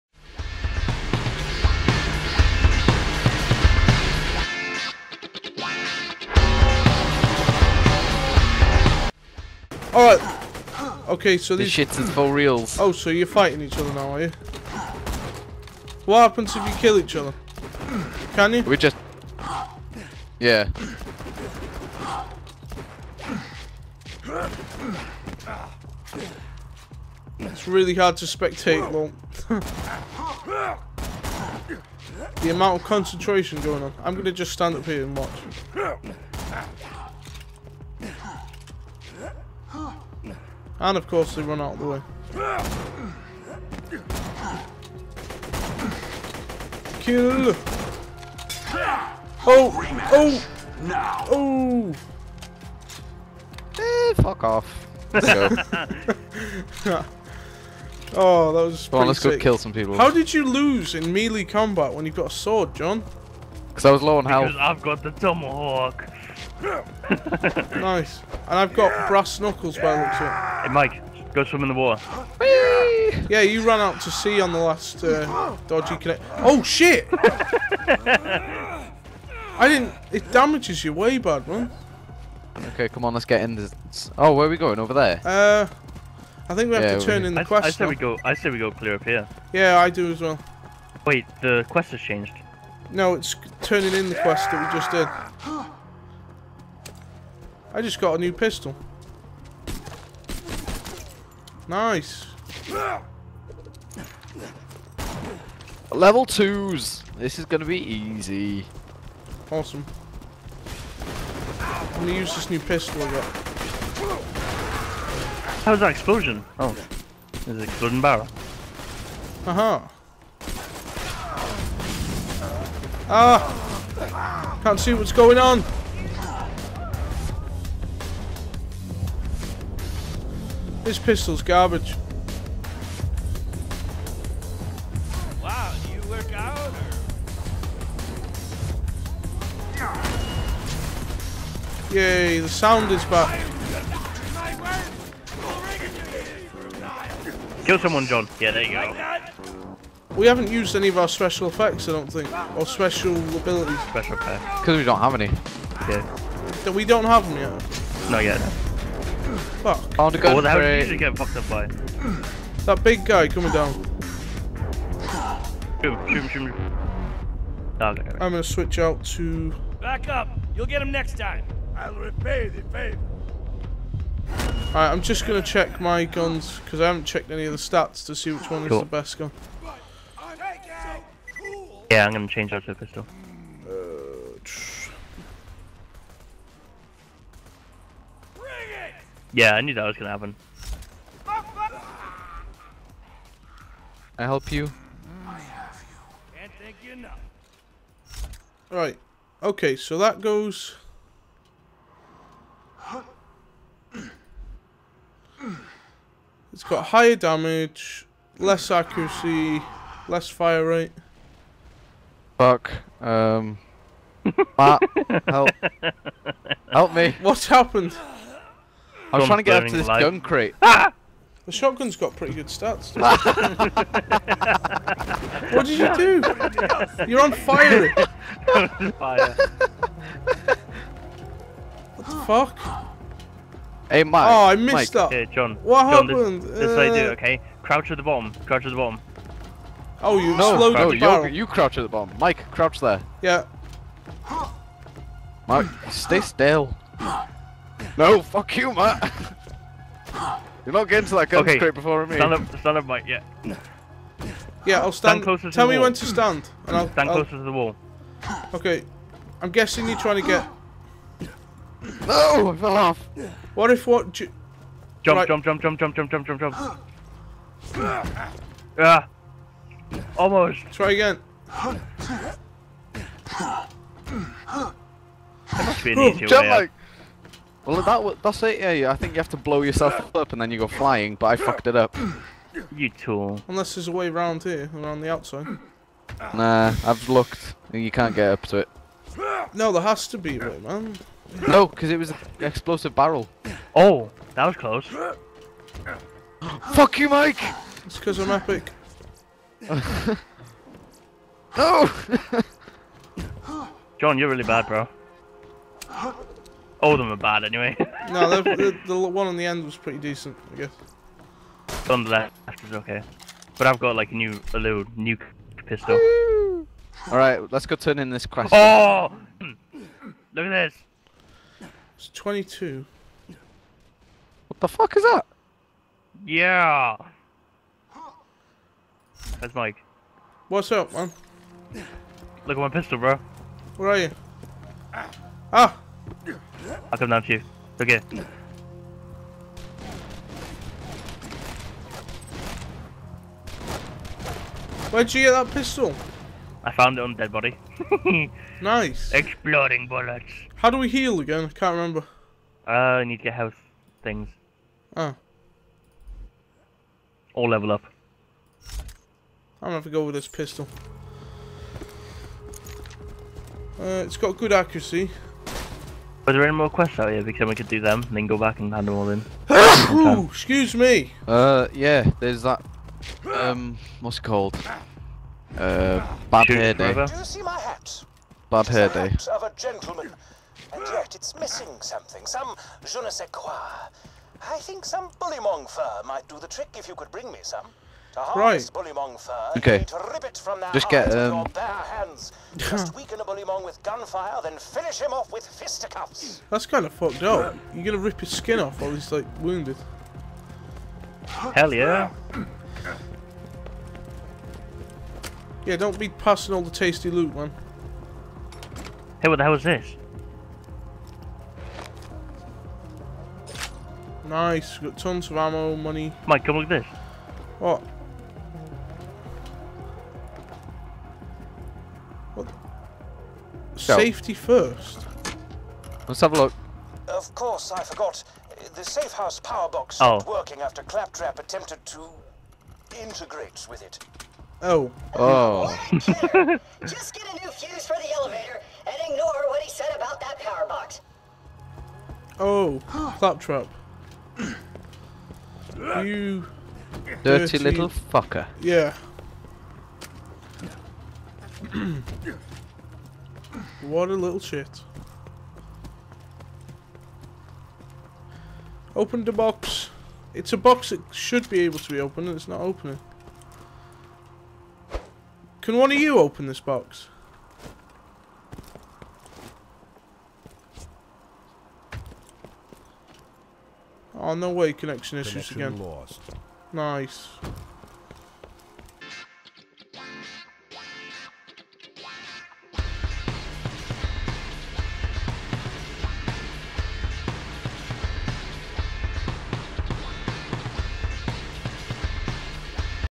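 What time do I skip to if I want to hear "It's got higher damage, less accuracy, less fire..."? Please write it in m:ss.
3:26.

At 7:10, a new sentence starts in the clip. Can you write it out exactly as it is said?
working after Claptrap attempted to integrate with it.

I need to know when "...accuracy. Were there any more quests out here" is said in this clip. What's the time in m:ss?
6:04.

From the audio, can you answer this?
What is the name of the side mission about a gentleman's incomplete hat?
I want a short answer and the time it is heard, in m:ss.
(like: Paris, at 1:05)
Bad hair day, at 6:18.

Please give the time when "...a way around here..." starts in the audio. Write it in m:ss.
4:43.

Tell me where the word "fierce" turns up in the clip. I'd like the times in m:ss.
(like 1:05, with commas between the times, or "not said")
not said.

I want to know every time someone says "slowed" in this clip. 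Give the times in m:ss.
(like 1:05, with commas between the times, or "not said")
4:00.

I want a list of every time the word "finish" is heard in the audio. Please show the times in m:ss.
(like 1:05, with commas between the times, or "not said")
6:34.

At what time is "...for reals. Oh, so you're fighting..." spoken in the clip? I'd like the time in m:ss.
0:12.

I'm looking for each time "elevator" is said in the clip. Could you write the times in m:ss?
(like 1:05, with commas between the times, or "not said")
7:18.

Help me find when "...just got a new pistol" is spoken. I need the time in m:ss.
1:37.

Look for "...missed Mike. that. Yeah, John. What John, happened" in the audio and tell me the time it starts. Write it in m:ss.
3:54.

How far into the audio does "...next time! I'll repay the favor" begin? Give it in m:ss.
2:50.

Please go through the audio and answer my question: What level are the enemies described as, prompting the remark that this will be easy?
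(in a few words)
Level twos.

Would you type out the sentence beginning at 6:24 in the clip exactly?
I think some bullymong fur might do the trick if you could bring me some.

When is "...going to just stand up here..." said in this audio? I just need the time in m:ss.
0:34.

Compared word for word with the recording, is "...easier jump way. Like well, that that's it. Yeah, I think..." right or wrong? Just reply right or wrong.
right.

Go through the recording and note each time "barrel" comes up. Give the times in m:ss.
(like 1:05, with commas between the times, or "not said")
1:58, 4:00, 4:52.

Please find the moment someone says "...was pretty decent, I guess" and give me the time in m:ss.
5:09.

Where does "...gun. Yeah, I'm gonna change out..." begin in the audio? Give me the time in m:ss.
2:59.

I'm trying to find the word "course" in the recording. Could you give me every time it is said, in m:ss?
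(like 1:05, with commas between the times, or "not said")
0:41, 7:07.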